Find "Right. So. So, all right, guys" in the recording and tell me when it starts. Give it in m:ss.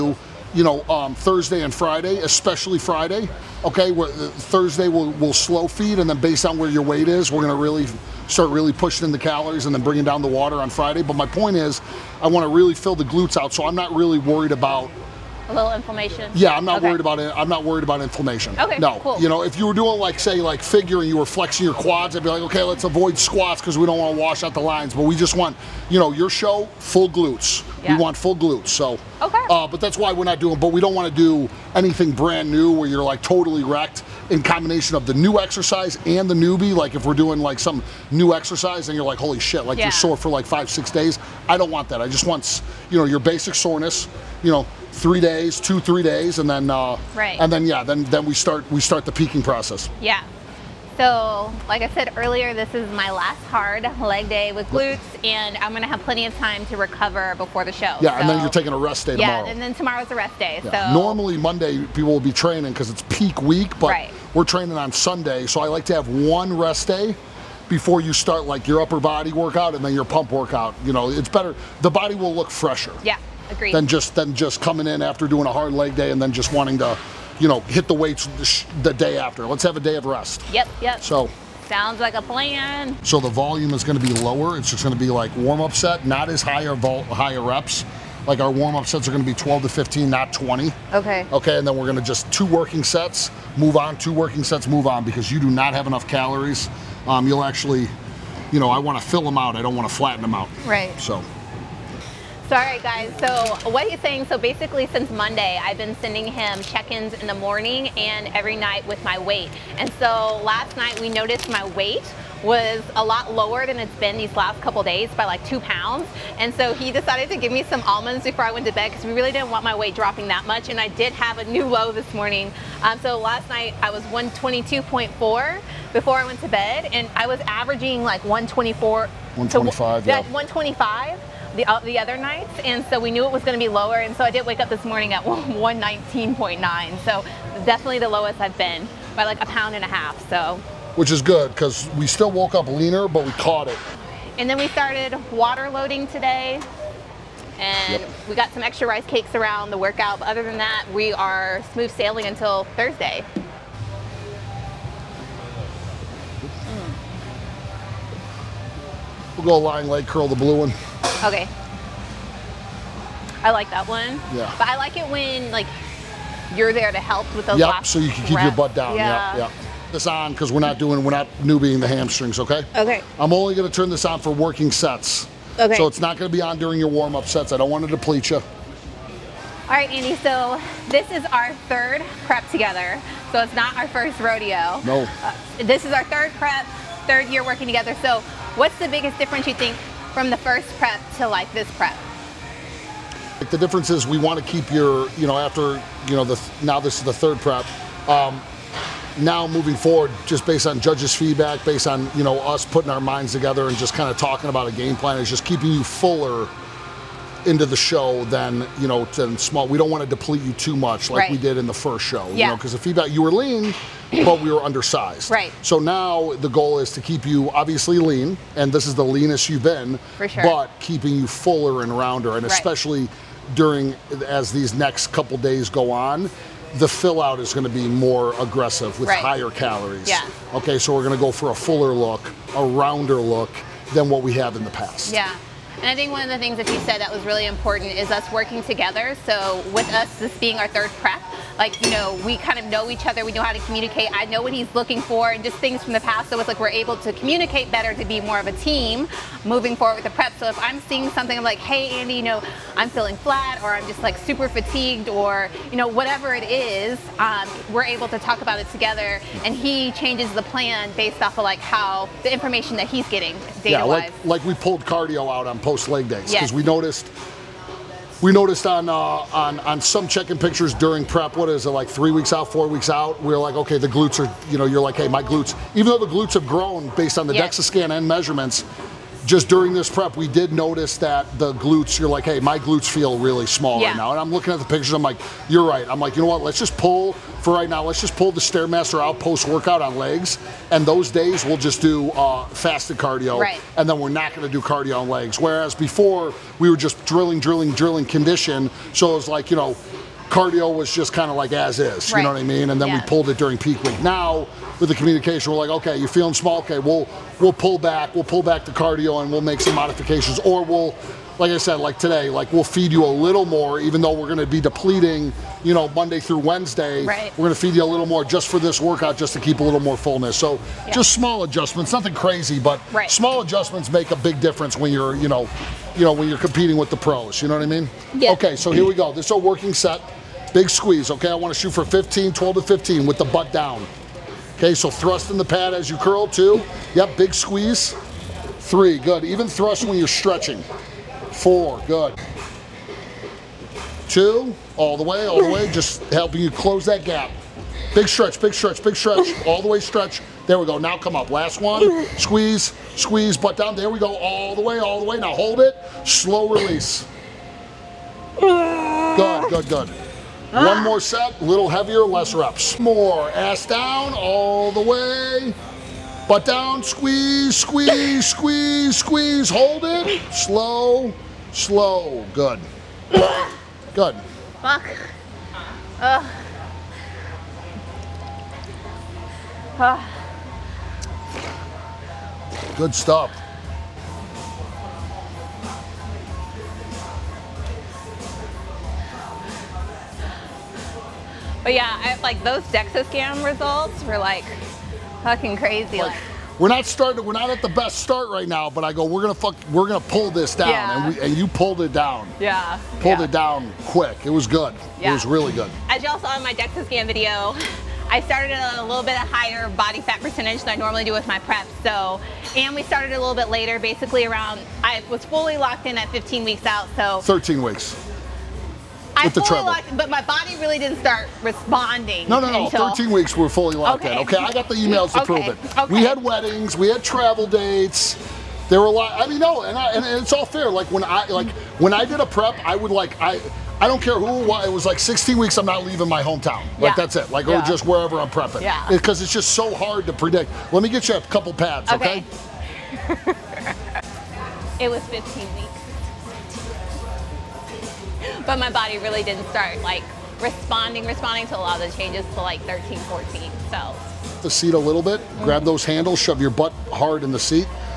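1:40.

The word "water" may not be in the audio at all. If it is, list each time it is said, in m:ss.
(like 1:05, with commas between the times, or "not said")
0:10, 2:25.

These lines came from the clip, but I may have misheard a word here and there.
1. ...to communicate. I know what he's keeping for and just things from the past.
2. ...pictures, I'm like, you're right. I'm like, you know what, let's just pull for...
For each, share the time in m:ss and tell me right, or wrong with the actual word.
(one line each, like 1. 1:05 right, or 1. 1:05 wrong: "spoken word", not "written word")
1. 4:03 wrong: "looking", not "keeping"
2. 4:44 right.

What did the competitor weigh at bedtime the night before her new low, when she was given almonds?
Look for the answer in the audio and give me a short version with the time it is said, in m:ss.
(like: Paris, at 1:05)
122.4, at 2:04.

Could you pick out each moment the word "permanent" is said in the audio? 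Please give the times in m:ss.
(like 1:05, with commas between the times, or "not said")
not said.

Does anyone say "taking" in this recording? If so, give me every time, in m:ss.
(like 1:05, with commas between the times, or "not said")
0:58.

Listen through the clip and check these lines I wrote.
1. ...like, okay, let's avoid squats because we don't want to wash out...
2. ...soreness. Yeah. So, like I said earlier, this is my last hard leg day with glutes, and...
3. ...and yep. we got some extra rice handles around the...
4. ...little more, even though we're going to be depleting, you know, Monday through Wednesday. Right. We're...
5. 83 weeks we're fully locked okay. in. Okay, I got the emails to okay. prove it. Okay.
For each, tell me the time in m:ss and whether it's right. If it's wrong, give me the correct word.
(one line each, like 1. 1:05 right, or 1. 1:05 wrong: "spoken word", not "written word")
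1. 0:22 right
2. 0:49 wrong: "process", not "soreness"
3. 2:27 wrong: "cakes", not "handles"
4. 5:13 right
5. 7:02 wrong: "13", not "83".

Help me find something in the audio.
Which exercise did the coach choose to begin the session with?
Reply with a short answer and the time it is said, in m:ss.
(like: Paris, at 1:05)
lying leg curl, at 2:39.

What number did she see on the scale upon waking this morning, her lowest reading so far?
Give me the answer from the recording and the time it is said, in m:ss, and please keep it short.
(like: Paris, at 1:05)
119.9, at 2:15.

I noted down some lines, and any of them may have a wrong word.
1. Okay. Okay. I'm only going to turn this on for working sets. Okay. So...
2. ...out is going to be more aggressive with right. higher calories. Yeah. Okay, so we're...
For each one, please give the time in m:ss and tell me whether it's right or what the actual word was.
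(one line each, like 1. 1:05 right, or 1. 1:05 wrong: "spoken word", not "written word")
1. 2:52 right
2. 3:47 right.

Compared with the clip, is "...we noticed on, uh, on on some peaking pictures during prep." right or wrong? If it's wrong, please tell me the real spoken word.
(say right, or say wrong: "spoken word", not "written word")
wrong: "checking", not "peaking".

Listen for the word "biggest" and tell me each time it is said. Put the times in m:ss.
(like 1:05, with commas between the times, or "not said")
3:08.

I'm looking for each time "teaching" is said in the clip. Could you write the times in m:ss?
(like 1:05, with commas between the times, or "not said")
not said.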